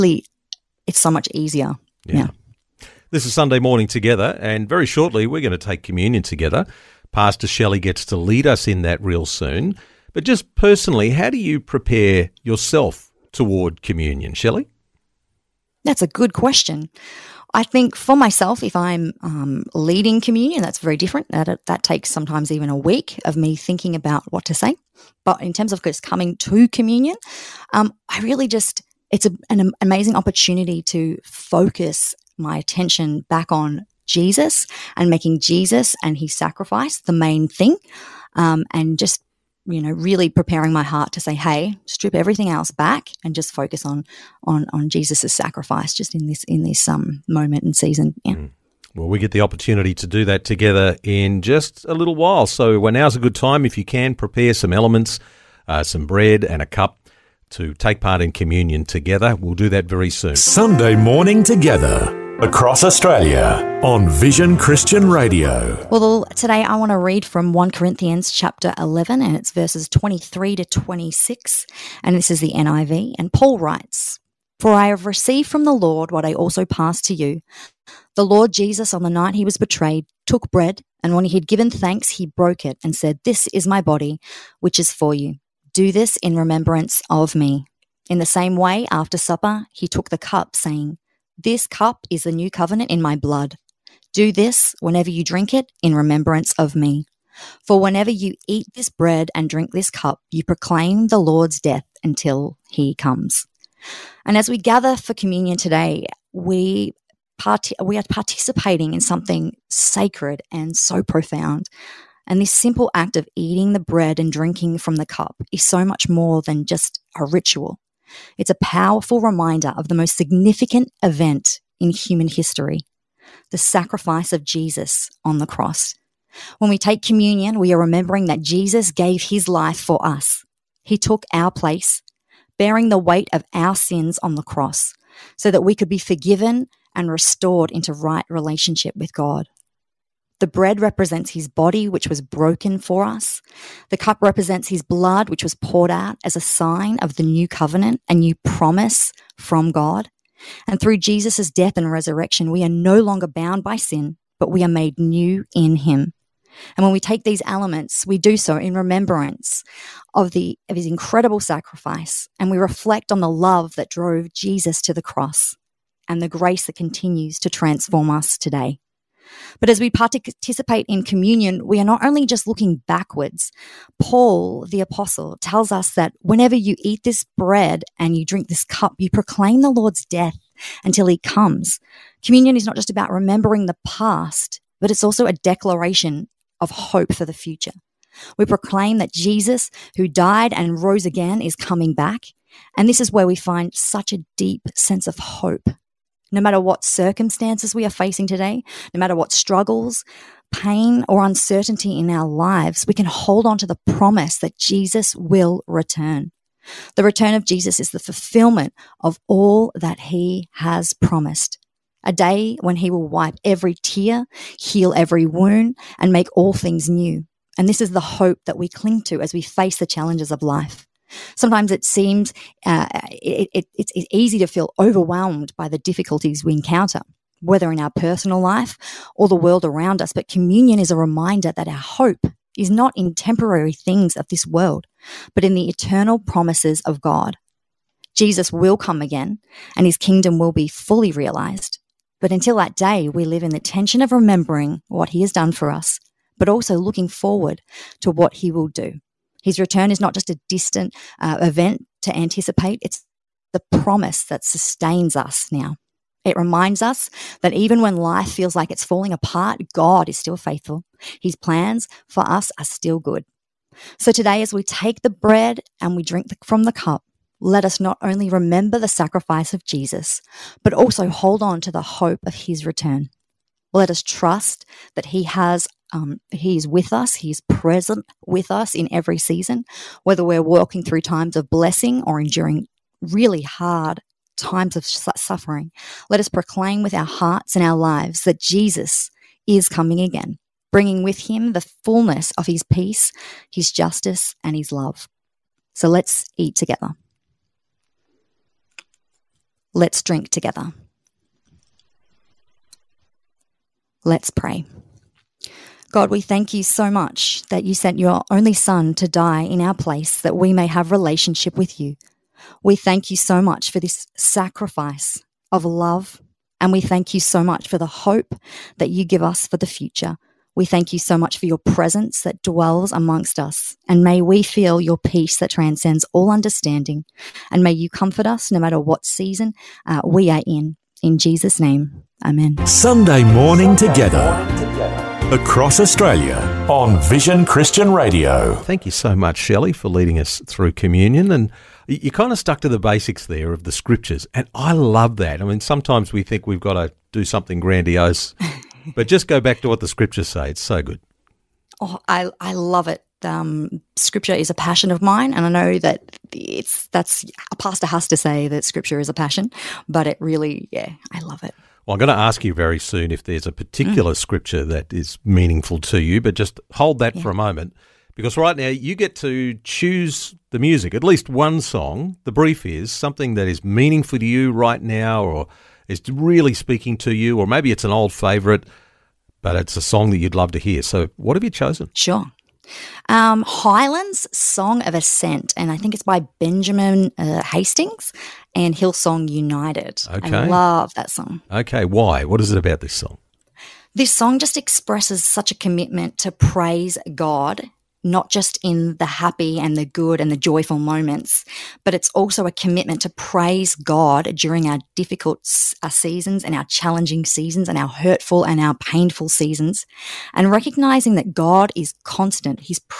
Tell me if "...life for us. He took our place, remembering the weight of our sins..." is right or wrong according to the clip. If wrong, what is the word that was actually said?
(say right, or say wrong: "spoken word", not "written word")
wrong: "bearing", not "remembering".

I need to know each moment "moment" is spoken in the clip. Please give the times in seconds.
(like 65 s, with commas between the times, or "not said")
47 s, 367 s, 400 s.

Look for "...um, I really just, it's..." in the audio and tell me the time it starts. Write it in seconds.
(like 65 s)
27 s.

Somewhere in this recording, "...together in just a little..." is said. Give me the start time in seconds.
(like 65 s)
50 s.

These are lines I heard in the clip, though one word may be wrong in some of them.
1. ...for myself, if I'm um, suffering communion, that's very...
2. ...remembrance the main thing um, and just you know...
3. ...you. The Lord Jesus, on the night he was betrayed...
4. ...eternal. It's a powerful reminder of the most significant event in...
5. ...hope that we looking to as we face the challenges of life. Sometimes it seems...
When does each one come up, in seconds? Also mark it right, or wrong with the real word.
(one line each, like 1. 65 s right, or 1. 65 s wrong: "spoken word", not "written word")
1. 17 s wrong: "leading", not "suffering"
2. 36 s wrong: "sacrifice", not "remembrance"
3. 77 s right
4. 117 s wrong: "ritual", not "eternal"
5. 218 s wrong: "cling", not "looking".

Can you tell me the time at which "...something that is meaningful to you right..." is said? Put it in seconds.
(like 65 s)
372 s.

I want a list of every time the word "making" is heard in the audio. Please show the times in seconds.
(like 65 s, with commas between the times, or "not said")
35 s.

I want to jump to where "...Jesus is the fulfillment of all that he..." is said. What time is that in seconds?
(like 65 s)
207 s.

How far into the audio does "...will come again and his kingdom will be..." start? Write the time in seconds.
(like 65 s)
238 s.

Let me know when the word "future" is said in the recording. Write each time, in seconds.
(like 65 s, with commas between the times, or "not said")
187 s, 319 s.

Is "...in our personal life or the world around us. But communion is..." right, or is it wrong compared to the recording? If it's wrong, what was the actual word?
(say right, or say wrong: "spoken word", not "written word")
right.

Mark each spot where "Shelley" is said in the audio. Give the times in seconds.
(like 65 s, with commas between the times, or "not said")
7 s, 14 s, 339 s.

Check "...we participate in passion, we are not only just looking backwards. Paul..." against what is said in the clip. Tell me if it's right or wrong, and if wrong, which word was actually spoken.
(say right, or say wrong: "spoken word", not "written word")
wrong: "communion", not "passion".